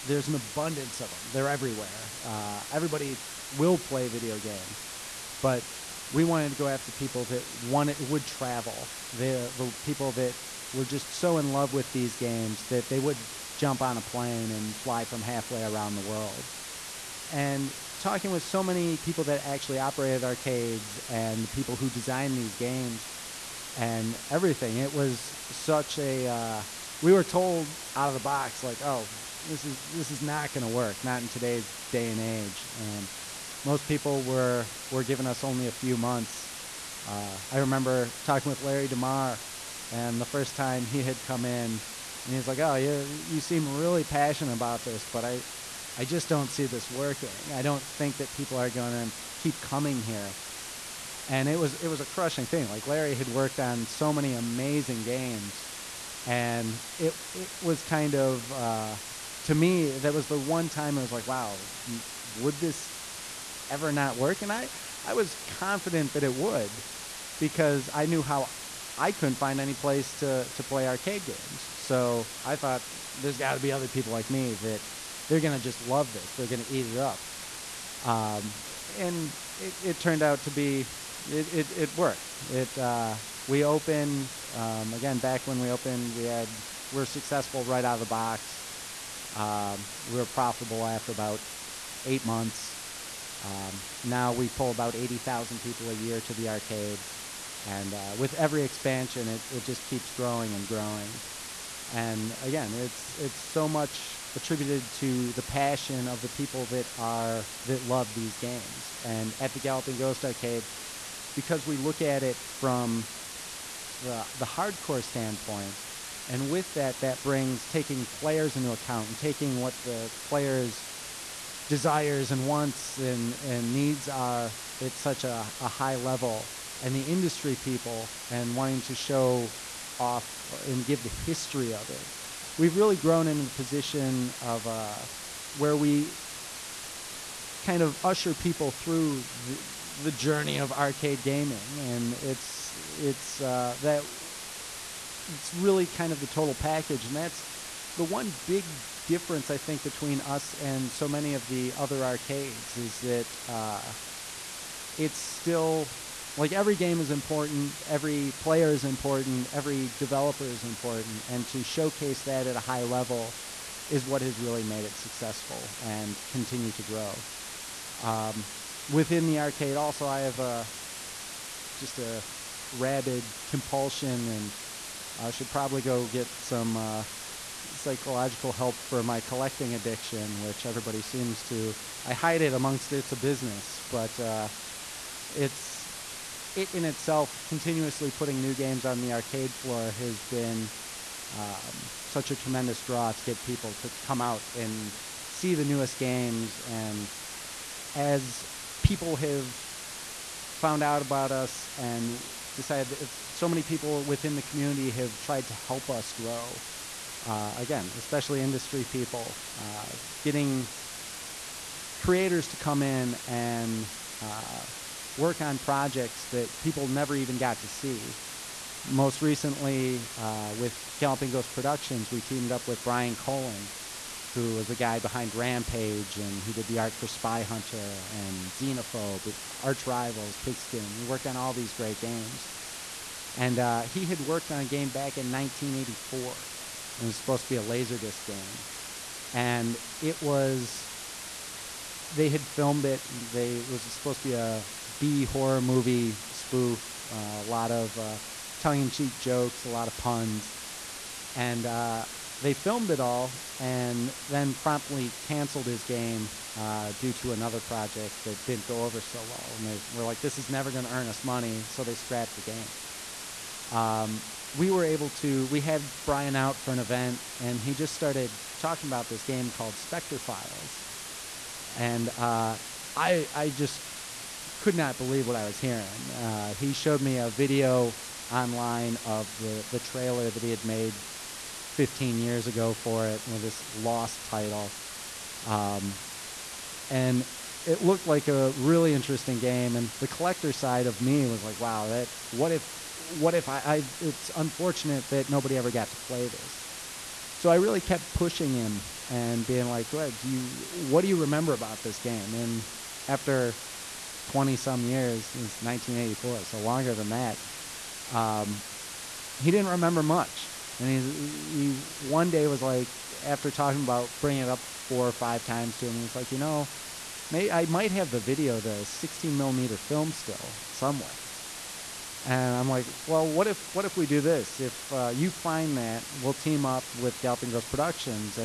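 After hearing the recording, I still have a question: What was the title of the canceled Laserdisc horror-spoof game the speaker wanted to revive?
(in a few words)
Spectre Files.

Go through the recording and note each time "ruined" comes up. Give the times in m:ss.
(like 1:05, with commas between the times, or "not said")
not said.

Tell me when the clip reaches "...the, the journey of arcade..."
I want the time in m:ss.
2:19.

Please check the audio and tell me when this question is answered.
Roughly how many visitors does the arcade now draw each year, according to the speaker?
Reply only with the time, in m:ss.
1:34.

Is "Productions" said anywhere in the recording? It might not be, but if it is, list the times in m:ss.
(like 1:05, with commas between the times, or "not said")
3:41, 5:27.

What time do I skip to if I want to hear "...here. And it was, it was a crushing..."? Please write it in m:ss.
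0:50.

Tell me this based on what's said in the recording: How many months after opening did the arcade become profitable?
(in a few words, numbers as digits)
8.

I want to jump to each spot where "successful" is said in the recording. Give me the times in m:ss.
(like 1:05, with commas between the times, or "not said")
1:27, 2:44.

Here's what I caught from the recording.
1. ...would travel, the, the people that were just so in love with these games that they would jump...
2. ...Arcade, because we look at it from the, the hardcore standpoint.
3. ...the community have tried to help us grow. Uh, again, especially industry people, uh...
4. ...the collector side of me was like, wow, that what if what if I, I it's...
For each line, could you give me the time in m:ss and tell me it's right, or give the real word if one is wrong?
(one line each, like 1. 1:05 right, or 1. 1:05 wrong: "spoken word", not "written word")
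1. 0:07 right
2. 1:50 right
3. 3:24 right
4. 4:49 right.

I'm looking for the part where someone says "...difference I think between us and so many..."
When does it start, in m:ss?
2:29.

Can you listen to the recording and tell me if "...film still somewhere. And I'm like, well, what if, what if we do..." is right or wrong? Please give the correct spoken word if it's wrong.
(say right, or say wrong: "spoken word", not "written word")
right.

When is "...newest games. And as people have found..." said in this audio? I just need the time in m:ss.
3:15.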